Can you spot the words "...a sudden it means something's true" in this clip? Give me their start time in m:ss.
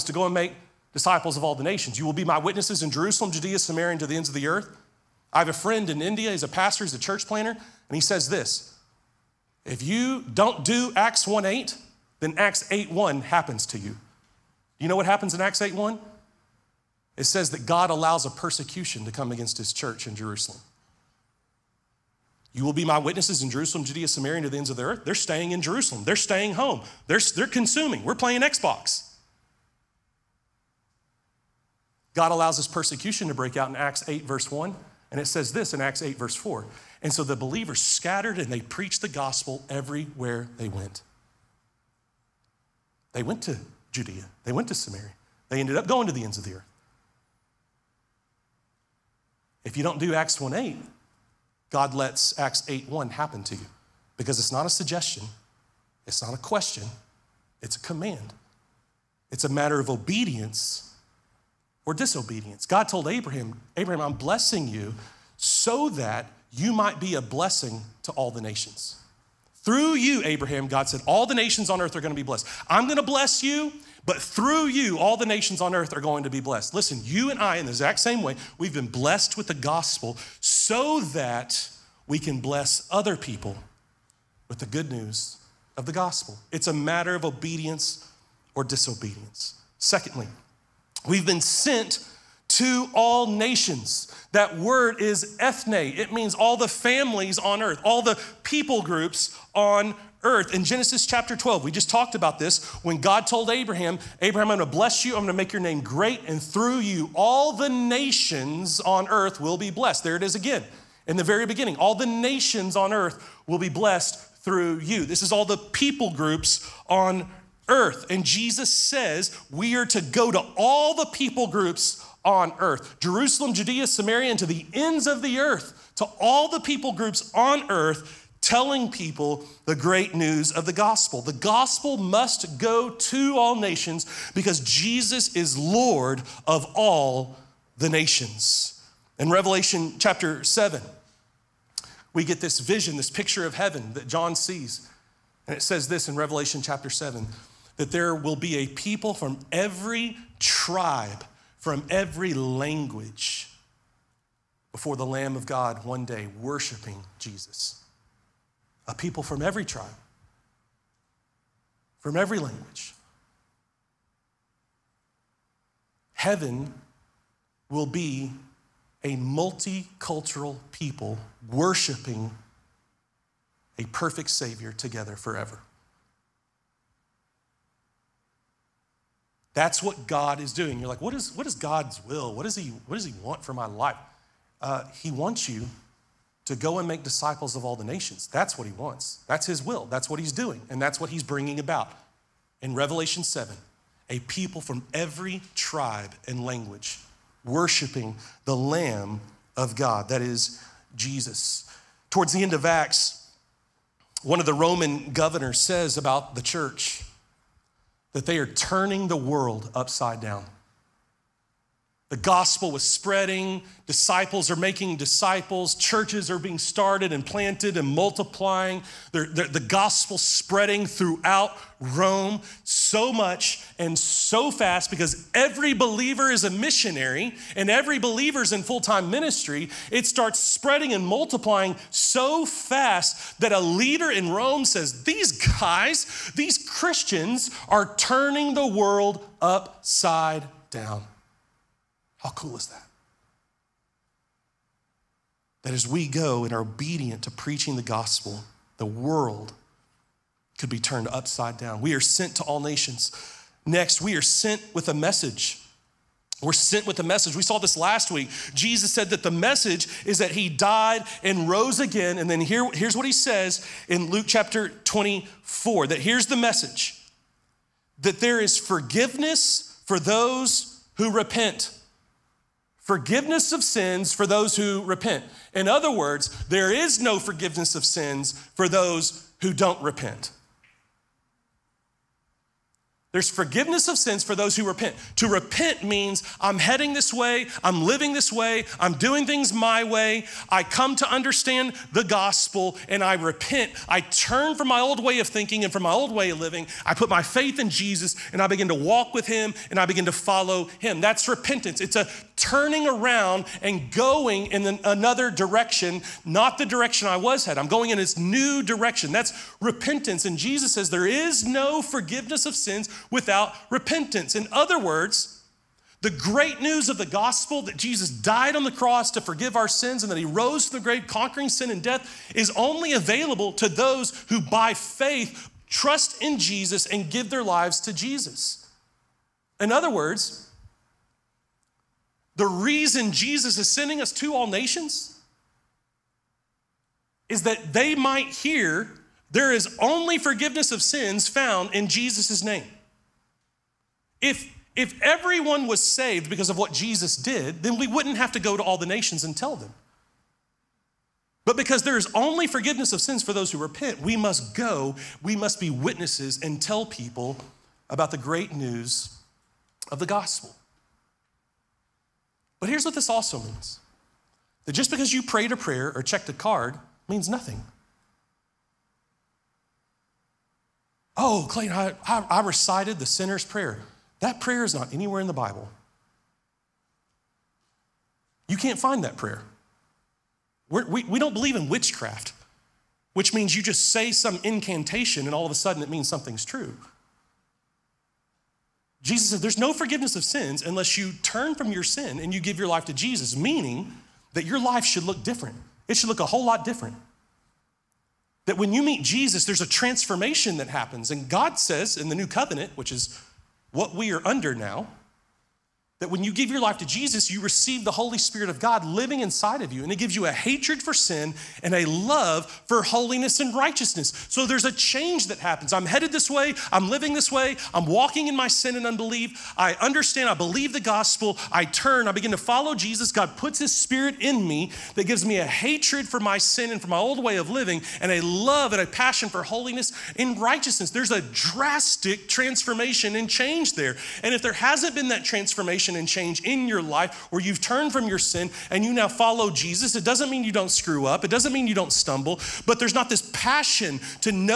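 6:25.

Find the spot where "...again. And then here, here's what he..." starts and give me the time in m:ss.
4:21.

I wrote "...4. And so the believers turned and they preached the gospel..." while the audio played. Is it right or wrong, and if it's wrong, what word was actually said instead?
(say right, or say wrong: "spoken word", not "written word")
wrong: "scattered", not "turned".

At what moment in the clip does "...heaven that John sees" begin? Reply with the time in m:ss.
2:23.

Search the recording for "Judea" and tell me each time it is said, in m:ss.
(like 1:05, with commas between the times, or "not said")
0:03, 0:23, 0:43, 2:03.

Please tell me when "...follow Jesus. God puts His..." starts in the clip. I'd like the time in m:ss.
7:02.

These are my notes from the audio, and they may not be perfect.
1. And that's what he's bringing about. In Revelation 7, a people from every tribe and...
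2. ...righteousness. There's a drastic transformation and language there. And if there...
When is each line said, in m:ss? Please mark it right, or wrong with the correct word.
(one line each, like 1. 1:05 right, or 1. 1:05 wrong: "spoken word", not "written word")
1. 3:10 right
2. 7:10 wrong: "change", not "language".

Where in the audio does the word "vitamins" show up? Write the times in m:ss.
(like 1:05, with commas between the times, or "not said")
not said.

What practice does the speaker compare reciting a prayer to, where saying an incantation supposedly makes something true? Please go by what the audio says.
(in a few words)
witchcraft.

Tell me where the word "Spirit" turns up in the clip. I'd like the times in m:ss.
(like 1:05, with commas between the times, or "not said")
6:48, 7:03.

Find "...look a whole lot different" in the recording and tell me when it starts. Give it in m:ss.
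6:36.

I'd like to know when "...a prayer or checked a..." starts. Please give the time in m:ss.
6:05.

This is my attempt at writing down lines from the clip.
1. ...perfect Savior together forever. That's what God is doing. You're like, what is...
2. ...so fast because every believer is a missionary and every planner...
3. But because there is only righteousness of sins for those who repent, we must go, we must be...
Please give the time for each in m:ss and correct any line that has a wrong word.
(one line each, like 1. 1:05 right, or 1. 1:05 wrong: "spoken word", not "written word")
1. 2:53 right
2. 3:43 wrong: "believer", not "planner"
3. 5:51 wrong: "forgiveness", not "righteousness".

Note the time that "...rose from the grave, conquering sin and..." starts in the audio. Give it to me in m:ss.
5:20.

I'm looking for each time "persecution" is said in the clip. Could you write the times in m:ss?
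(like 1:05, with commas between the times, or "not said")
0:18, 0:32.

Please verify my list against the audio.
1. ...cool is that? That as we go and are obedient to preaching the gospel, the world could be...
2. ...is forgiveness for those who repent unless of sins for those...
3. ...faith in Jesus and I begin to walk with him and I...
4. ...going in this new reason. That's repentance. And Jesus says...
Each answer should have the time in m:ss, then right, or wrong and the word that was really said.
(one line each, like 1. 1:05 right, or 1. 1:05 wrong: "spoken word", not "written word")
1. 4:02 right
2. 4:28 wrong: "forgiveness", not "unless"
3. 4:57 right
4. 5:07 wrong: "direction", not "reason".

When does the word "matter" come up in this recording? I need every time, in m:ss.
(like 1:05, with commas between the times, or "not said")
0:59, 1:26.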